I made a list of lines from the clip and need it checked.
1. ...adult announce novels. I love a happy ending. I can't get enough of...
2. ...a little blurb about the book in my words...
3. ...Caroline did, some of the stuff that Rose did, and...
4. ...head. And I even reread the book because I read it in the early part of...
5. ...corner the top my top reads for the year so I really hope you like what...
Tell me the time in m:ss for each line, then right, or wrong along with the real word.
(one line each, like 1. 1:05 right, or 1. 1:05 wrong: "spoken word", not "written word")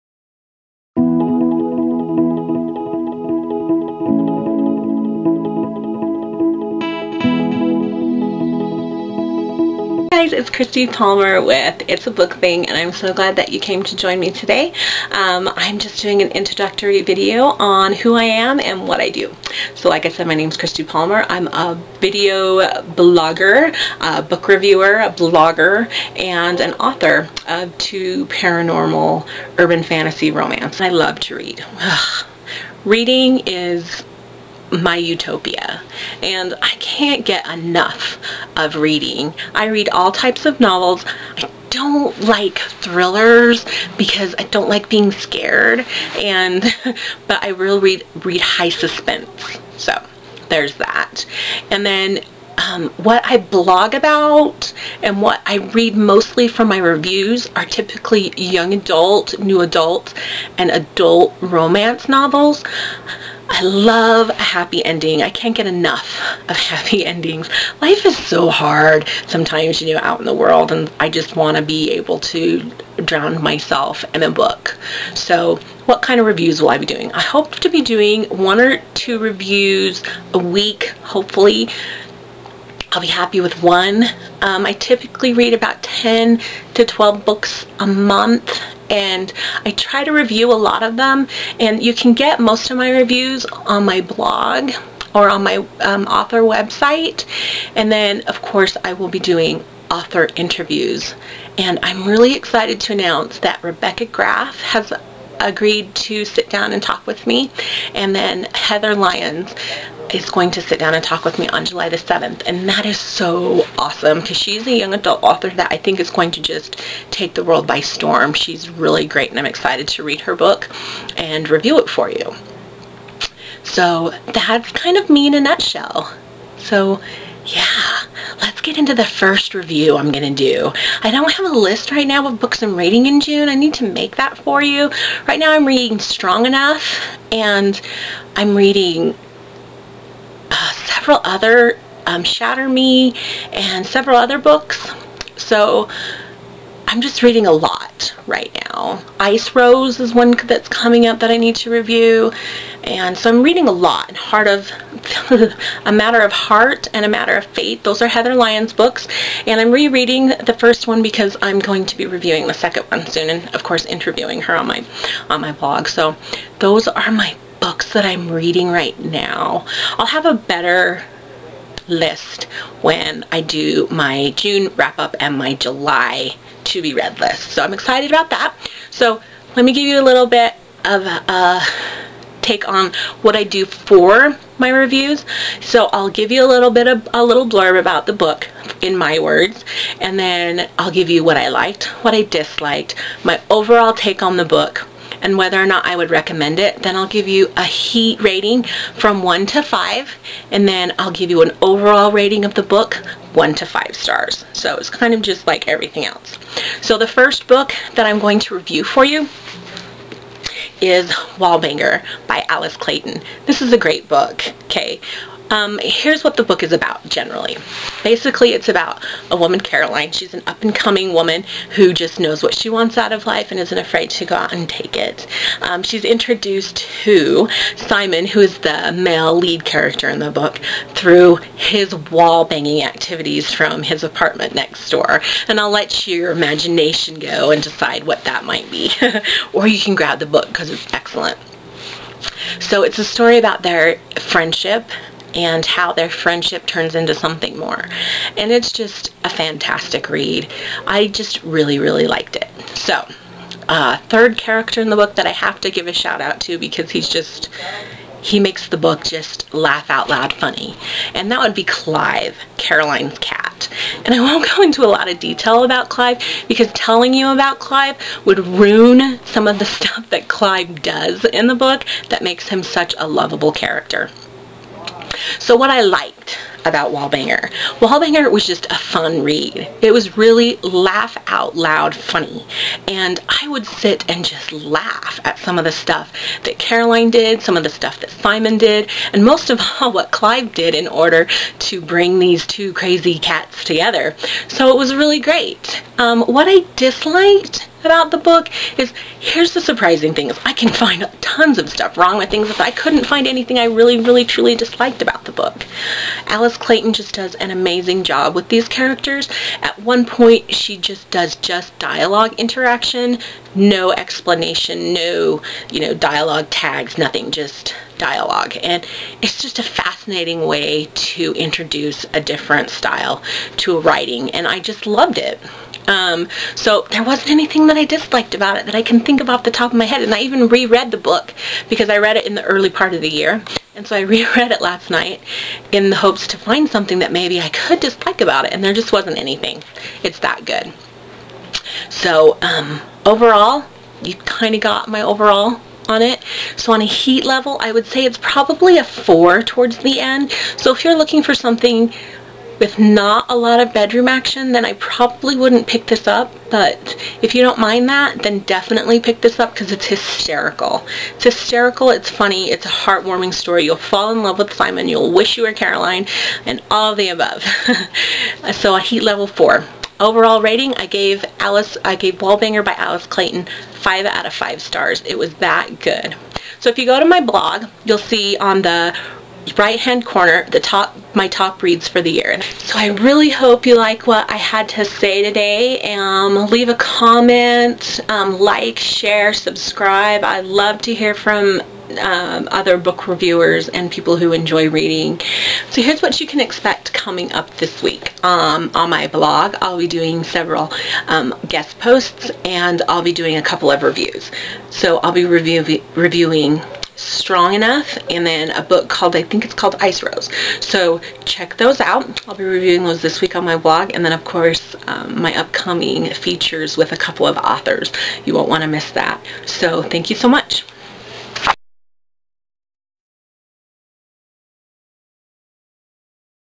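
1. 1:00 wrong: "romance", not "announce"
2. 3:07 right
3. 4:46 wrong: "Simon", not "Rose"
4. 5:29 right
5. 6:20 right.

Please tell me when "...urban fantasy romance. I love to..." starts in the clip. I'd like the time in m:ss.
0:29.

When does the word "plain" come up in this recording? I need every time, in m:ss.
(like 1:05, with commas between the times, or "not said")
not said.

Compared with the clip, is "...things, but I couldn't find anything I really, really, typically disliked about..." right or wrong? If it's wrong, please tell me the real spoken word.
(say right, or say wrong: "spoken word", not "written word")
wrong: "truly", not "typically".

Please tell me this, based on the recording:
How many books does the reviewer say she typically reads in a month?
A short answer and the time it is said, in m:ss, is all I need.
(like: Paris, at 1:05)
10 to 12, at 1:25.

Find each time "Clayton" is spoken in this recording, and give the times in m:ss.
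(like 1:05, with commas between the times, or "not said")
3:32, 5:06, 6:13.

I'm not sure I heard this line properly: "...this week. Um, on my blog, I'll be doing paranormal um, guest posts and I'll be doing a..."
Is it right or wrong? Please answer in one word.
wrong.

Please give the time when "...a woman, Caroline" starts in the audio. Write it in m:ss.
3:39.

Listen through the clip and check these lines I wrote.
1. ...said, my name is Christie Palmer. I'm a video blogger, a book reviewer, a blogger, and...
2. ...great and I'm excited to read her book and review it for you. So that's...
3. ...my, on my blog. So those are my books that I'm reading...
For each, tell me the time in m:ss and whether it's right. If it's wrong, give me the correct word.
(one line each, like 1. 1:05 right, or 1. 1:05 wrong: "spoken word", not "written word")
1. 0:20 right
2. 1:59 right
3. 2:44 right.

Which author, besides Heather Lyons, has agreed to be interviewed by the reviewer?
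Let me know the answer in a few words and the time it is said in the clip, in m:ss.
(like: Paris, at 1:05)
Rebecca Graff, at 1:43.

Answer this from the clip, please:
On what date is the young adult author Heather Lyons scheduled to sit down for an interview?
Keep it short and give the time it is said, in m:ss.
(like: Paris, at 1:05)
July 7, at 1:51.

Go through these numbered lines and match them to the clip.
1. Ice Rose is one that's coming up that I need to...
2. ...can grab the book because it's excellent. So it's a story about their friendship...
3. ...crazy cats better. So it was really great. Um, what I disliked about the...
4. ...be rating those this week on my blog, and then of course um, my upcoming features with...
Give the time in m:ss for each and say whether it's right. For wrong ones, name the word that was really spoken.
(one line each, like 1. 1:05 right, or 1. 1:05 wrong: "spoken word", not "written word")
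1. 2:29 right
2. 3:59 right
3. 4:52 wrong: "together", not "better"
4. 6:52 wrong: "reviewing", not "rating".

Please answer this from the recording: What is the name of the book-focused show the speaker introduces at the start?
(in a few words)
It's a Book Thing.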